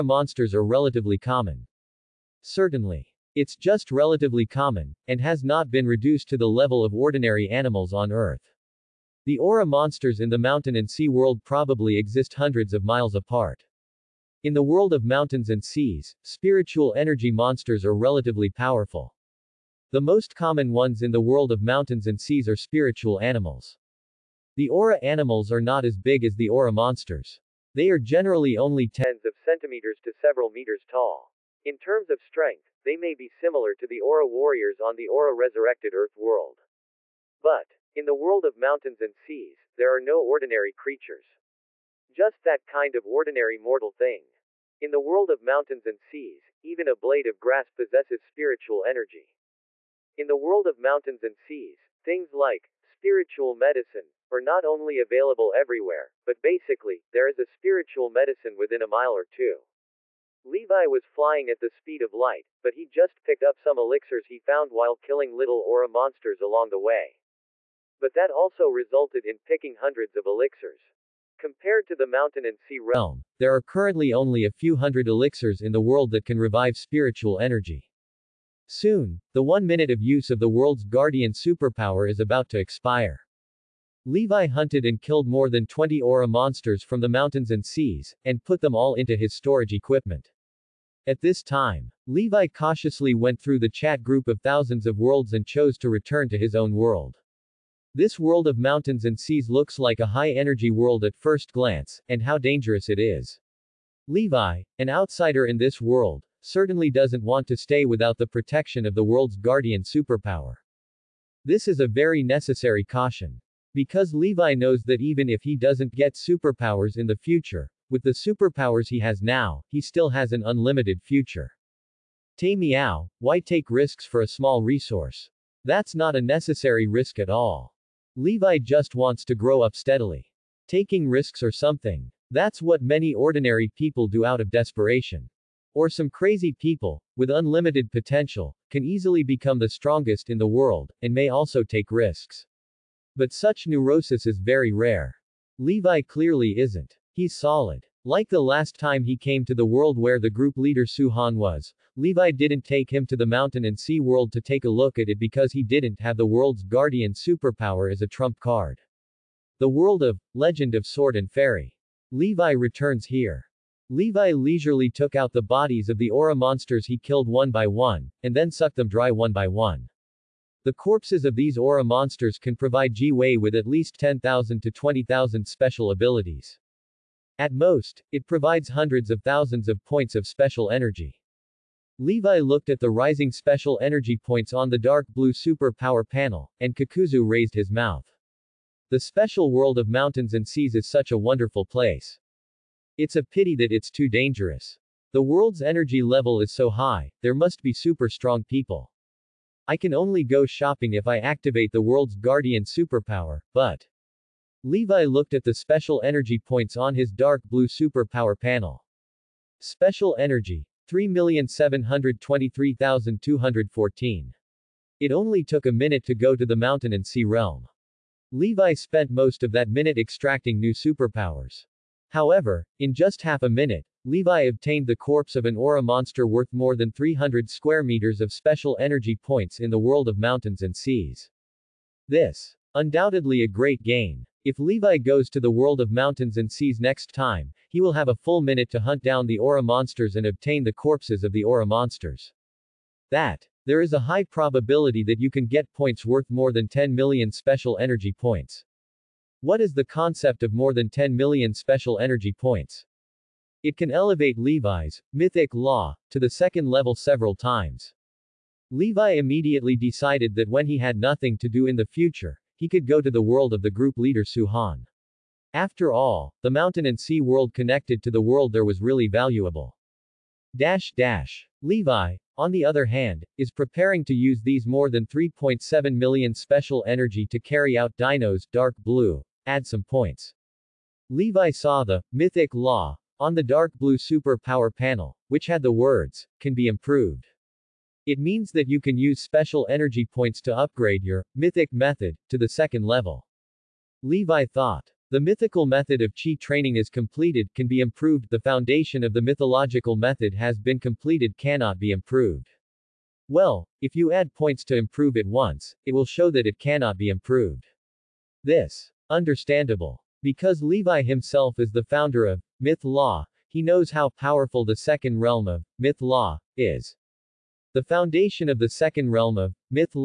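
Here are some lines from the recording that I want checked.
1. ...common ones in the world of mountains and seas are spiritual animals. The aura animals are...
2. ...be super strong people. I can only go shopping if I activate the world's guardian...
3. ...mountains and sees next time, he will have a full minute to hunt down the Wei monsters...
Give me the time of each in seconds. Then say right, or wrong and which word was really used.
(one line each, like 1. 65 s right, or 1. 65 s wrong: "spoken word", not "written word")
1. 20 s right
2. 197 s right
3. 235 s wrong: "Aura", not "Wei".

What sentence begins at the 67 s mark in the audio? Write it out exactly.
But that also resulted in picking hundreds of elixirs.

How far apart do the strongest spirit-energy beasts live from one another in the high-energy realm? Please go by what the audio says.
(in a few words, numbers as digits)
hundreds of miles.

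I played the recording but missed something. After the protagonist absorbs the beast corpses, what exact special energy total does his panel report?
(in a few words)
3,723,214.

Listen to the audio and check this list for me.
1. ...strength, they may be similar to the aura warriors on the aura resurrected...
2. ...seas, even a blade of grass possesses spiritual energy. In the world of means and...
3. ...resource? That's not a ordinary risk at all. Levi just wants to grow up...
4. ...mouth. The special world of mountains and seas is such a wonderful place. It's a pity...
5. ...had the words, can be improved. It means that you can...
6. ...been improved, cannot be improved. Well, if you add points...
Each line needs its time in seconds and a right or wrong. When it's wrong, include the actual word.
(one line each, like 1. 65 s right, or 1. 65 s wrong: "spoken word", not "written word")
1. 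32 s right
2. 46 s wrong: "mountains", not "means"
3. 124 s wrong: "necessary", not "ordinary"
4. 187 s right
5. 285 s right
6. 300 s wrong: "completed", not "improved".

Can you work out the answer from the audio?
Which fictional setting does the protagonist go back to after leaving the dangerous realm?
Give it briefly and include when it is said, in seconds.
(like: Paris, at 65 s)
Legend of Sword and Fairy, at 160 s.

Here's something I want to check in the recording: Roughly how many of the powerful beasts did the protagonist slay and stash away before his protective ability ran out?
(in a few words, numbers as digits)
more than 20.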